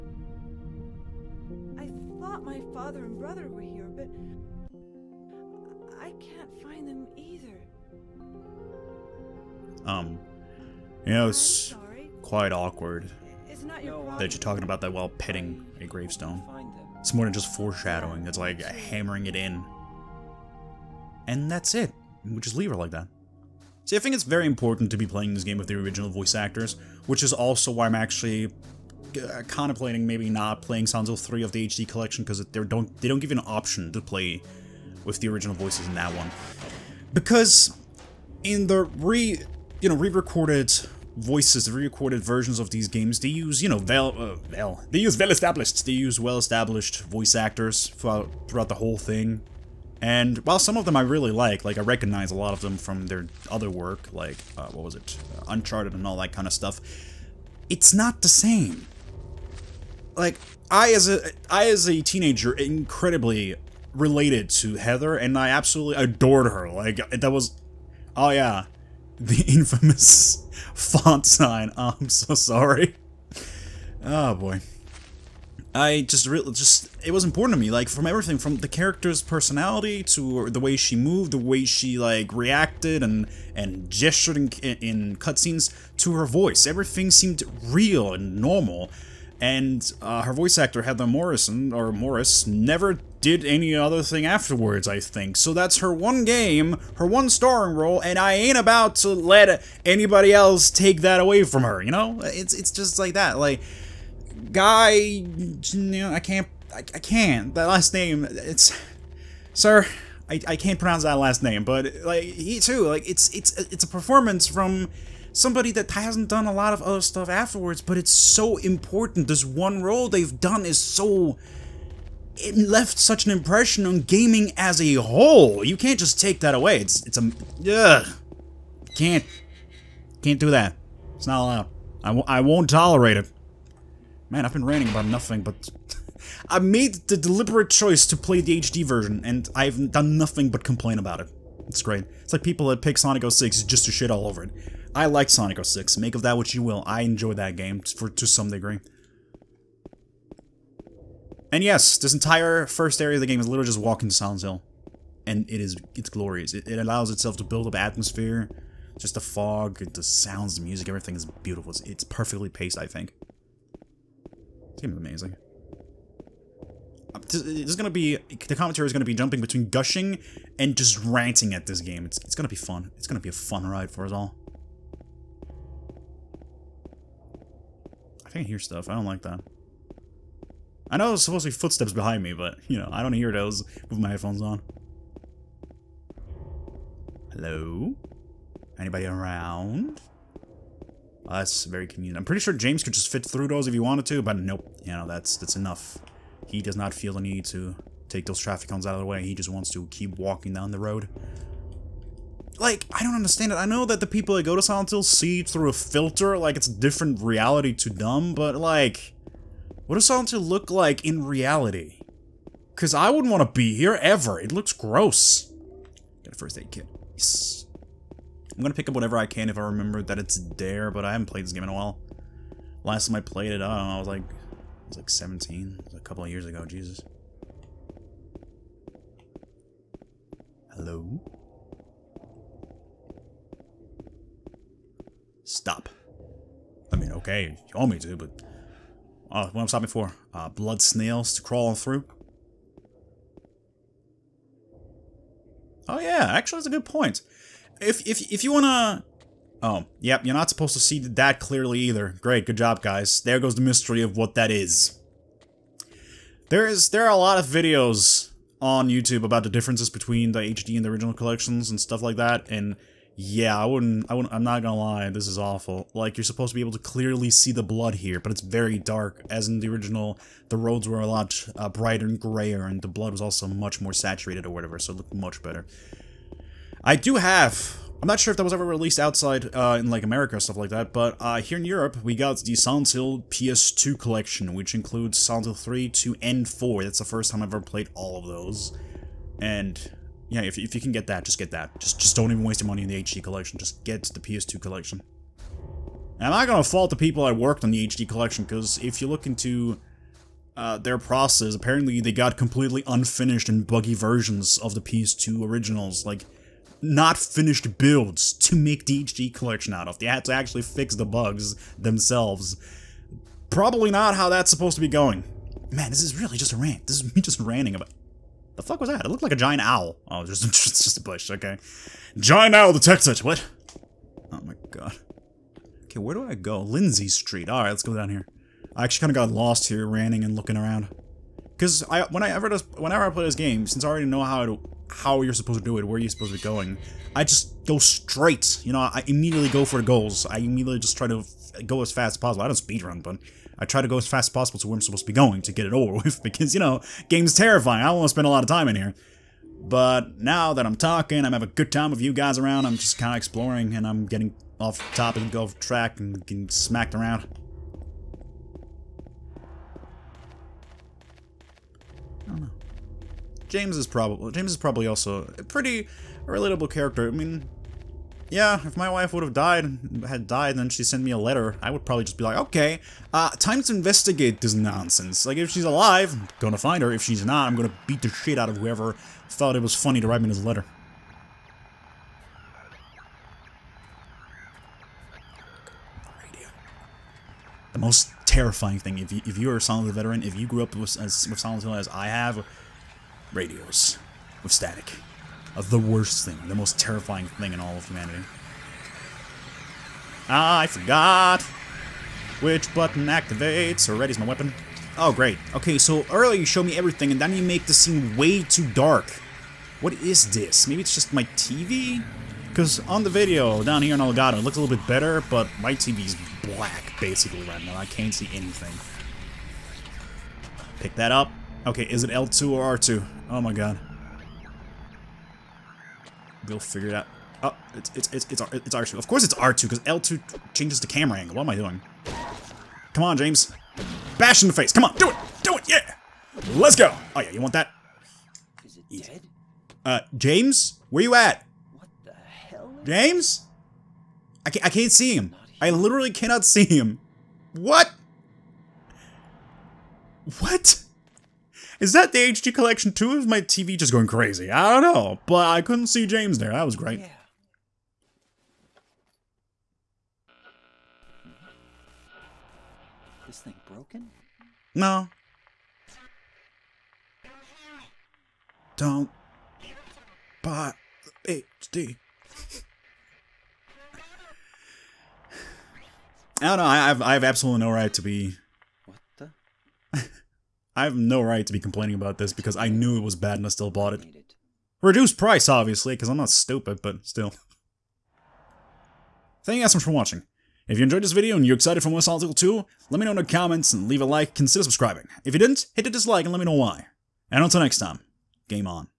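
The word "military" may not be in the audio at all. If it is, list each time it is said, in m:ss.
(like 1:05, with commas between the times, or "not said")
not said.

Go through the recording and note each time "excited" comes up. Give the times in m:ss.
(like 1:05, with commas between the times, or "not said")
8:11.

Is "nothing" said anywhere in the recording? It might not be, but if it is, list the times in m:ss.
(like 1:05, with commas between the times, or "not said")
2:15, 2:20.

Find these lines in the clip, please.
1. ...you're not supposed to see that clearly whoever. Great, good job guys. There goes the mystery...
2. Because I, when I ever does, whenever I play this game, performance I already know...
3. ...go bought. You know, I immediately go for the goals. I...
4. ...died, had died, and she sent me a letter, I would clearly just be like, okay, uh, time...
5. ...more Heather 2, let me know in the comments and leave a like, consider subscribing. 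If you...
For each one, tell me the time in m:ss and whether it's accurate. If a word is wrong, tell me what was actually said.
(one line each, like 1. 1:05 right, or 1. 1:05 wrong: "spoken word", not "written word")
1. 4:10 wrong: "either", not "whoever"
2. 5:31 wrong: "since", not "performance"
3. 5:37 wrong: "straight", not "bought"
4. 6:09 wrong: "probably", not "clearly"
5. 8:11 wrong: "Solid", not "Heather".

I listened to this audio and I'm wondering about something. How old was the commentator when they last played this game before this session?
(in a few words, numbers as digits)
17.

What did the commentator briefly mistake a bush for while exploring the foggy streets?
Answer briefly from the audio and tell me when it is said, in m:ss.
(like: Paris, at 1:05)
A giant owl, at 5:19.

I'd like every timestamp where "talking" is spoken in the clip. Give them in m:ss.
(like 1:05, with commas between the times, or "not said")
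0:14, 5:50.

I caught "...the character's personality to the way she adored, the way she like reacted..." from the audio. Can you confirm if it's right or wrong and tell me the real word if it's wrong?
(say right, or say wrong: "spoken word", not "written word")
wrong: "moved", not "adored".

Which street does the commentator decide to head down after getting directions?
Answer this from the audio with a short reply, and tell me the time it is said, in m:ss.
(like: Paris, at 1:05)
Lindsey Street, at 5:26.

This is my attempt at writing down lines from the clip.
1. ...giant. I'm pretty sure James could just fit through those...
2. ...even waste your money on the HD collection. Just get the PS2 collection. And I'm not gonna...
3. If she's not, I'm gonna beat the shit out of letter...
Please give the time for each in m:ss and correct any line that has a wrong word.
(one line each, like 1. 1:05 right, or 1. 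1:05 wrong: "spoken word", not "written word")
1. 3:11 wrong: "convenient", not "giant"
2. 4:52 right
3. 6:16 wrong: "whoever", not "letter".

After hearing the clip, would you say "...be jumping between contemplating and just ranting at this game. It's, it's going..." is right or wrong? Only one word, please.
wrong.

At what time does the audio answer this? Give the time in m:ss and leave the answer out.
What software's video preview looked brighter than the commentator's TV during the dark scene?
6:53.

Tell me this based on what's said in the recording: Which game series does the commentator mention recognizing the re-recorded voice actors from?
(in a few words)
Uncharted.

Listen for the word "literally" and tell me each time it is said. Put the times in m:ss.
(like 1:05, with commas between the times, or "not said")
2:33, 7:25.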